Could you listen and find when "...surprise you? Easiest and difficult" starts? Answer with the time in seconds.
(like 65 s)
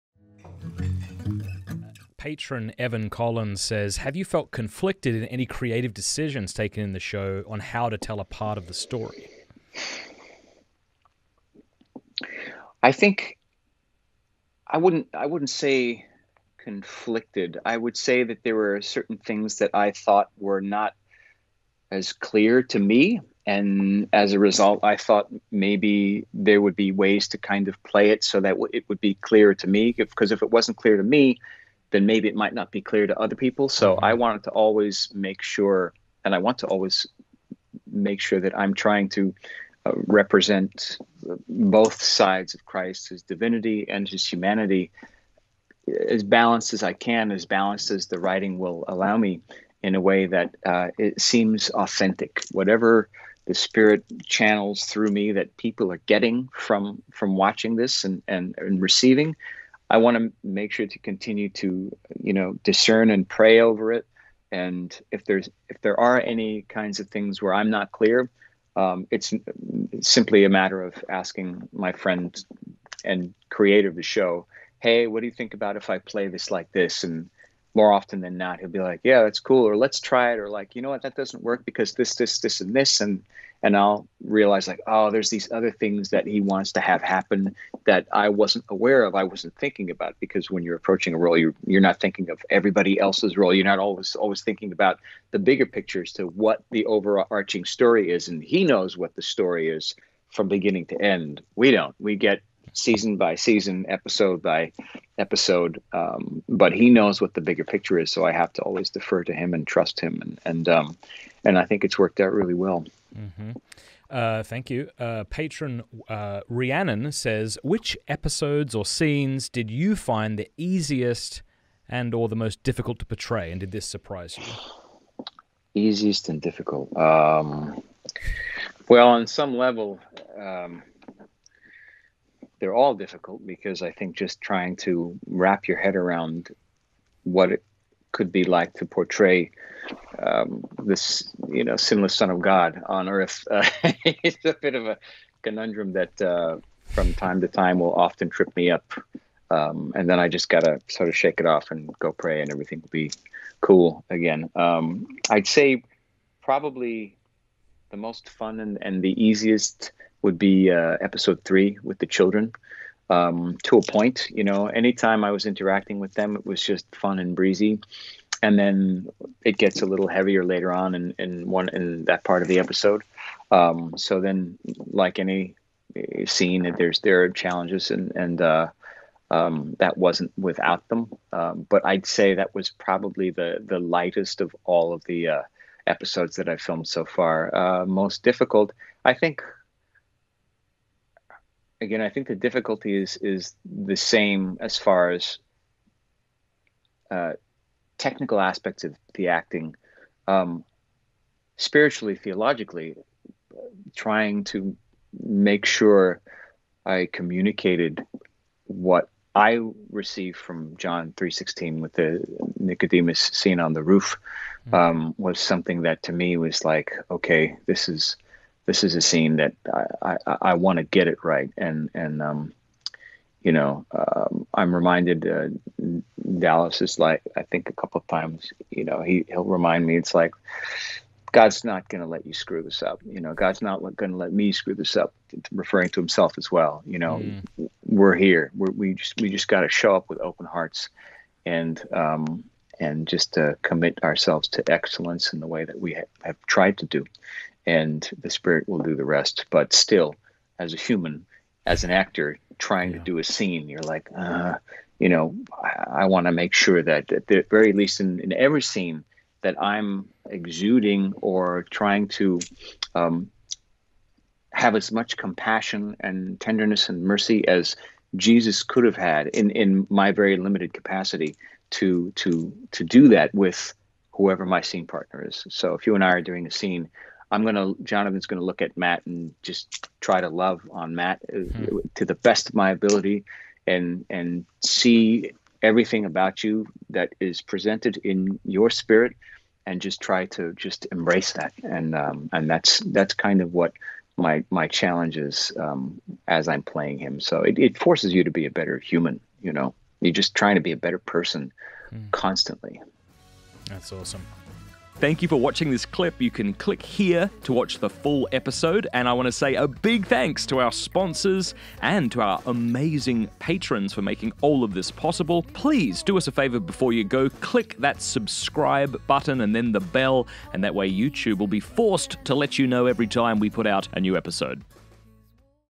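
123 s.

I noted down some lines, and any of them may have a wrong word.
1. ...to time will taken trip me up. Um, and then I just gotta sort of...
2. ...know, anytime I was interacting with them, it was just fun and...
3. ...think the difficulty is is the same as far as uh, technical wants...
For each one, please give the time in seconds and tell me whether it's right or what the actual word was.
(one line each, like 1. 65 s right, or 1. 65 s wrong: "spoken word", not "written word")
1. 147 s wrong: "often", not "taken"
2. 164 s right
3. 192 s wrong: "aspects", not "wants".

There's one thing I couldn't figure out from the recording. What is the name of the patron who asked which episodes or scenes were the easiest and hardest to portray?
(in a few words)
Rhiannon.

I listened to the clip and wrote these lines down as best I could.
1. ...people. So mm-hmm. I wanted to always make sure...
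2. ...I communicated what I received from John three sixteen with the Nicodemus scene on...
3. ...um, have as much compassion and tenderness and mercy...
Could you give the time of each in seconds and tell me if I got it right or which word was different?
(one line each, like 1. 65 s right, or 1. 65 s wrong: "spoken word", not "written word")
1. 33 s right
2. 206 s right
3. 262 s right.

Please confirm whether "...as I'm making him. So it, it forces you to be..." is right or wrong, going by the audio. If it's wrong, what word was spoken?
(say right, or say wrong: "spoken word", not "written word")
wrong: "playing", not "making".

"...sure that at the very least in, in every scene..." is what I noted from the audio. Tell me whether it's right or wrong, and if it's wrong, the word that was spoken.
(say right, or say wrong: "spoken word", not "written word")
right.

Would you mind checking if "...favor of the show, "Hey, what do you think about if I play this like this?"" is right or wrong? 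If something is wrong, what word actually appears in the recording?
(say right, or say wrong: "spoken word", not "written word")
wrong: "creator", not "favor".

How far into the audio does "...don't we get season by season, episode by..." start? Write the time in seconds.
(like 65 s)
101 s.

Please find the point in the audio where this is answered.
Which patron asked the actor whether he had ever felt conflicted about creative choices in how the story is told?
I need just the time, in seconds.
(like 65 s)
2 s.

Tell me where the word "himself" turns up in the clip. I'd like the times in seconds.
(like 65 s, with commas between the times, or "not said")
235 s.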